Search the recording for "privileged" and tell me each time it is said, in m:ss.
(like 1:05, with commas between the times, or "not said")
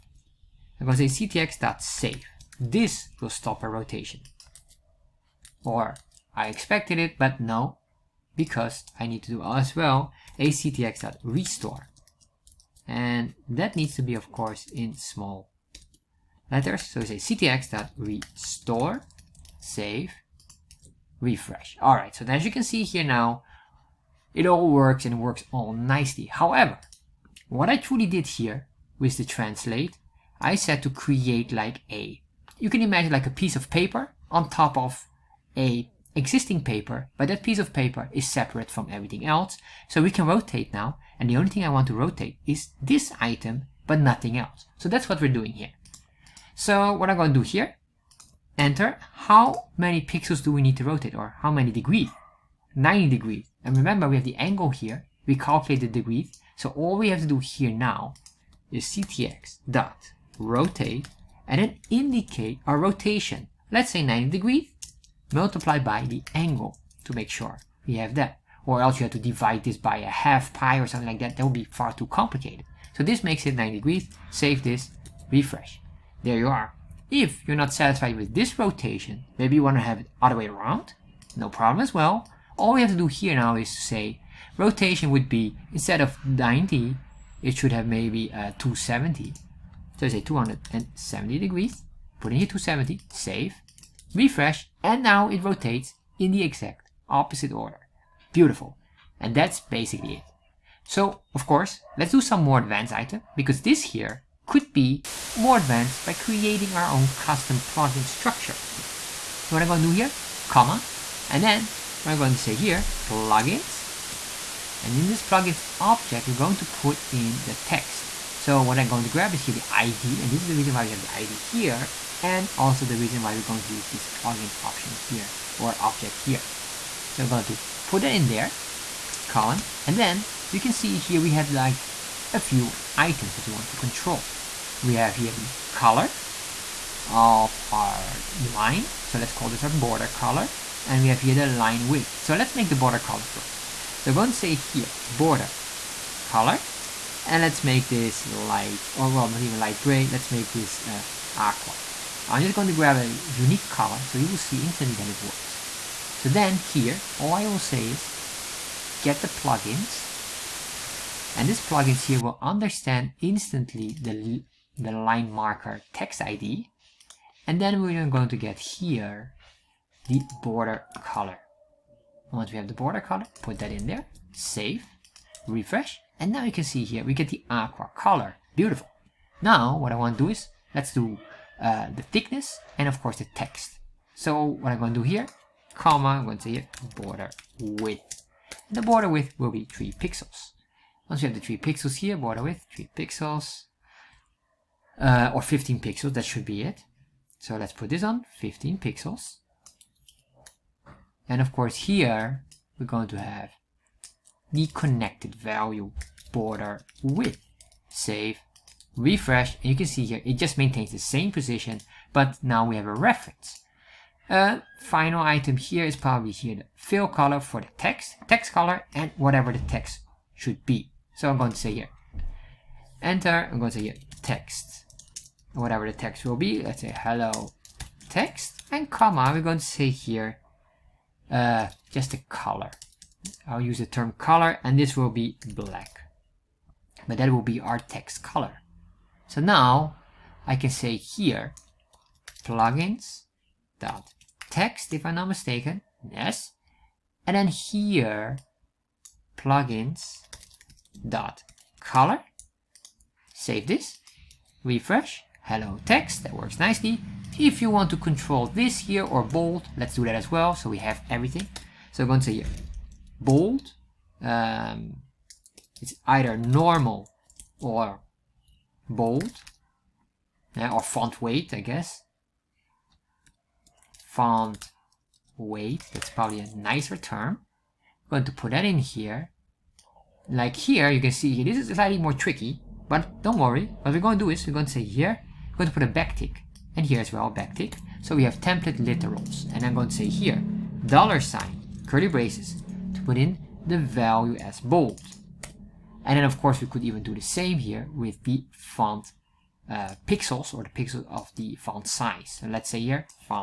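not said.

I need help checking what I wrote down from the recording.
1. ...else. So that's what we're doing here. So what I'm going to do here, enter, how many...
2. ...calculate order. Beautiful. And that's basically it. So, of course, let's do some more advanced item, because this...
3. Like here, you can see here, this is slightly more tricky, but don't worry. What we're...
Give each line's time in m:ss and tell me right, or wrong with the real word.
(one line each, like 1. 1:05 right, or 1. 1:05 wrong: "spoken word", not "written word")
1. 0:44 right
2. 1:37 wrong: "opposite", not "calculate"
3. 4:40 right.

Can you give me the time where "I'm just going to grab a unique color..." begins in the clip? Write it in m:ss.
2:32.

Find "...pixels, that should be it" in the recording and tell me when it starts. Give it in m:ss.
3:15.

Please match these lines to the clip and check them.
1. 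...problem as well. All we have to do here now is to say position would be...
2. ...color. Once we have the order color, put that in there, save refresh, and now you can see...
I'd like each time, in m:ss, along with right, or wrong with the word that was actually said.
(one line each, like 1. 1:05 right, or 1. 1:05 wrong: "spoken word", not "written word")
1. 1:21 wrong: "rotation", not "position"
2. 2:51 wrong: "border", not "order".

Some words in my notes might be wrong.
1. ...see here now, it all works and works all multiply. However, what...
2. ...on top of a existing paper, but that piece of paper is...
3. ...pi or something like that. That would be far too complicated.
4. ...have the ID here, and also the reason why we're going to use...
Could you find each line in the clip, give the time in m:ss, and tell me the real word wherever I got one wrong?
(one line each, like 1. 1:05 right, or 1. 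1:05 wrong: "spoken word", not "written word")
1. 0:22 wrong: "nicely", not "multiply"
2. 0:34 right
3. 1:10 right
4. 2:00 right.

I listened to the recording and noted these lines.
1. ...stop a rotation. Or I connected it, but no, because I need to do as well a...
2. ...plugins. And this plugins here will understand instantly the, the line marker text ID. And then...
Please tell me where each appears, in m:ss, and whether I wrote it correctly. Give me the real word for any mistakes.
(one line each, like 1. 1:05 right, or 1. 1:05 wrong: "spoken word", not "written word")
1. 0:03 wrong: "expected", not "connected"
2. 2:39 right.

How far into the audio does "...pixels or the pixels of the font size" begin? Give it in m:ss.
5:00.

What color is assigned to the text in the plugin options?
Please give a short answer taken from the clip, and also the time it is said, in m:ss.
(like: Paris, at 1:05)
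black, at 3:55.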